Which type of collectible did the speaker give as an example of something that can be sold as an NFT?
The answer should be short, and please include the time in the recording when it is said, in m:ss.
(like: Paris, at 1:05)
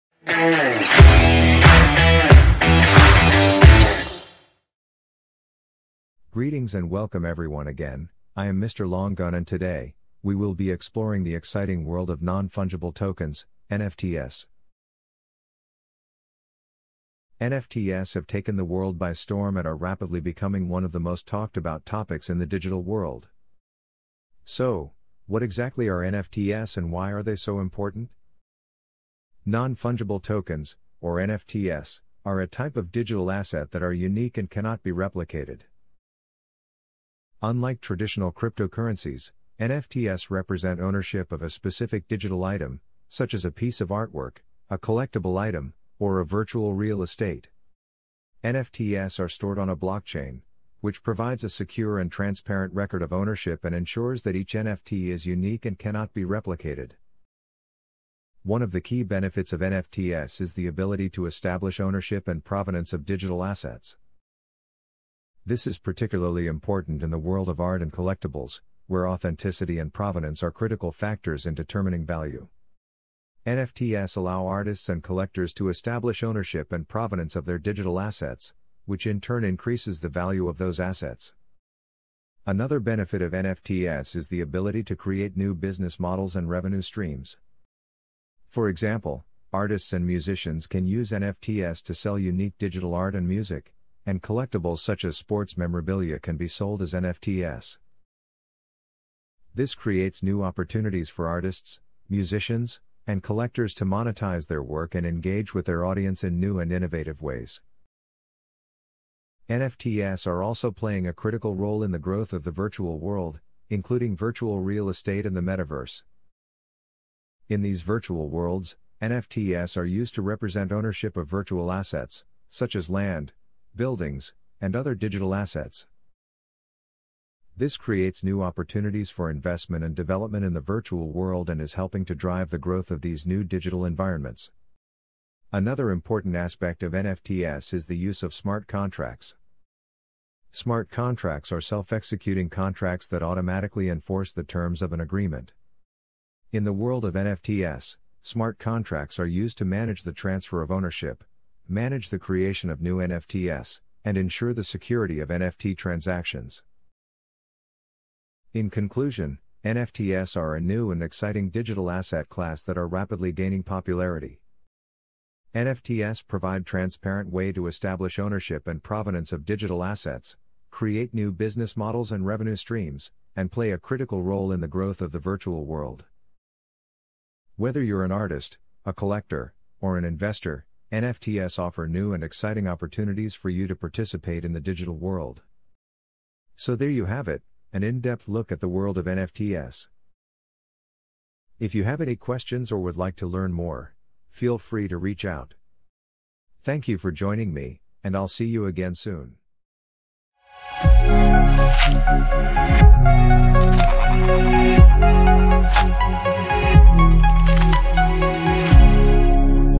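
sports memorabilia, at 1:35.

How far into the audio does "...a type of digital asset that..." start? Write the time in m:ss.
0:32.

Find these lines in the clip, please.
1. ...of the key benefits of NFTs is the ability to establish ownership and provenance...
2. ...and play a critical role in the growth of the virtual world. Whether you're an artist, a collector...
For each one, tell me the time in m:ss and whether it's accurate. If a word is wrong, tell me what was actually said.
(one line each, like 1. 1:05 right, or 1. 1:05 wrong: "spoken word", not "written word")
1. 0:58 right
2. 2:53 right.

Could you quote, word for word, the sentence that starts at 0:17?
NFTs have taken the world by storm and are rapidly becoming one of the most talked about topics in the digital world.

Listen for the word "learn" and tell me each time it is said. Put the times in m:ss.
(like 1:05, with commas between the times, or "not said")
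3:13.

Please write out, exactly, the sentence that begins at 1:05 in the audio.
This is particularly important in the world of art and collectibles, where authenticity and provenance are critical factors in determining value.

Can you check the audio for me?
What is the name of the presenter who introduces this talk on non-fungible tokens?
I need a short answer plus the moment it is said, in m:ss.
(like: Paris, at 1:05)
Mr. Longun, at 0:08.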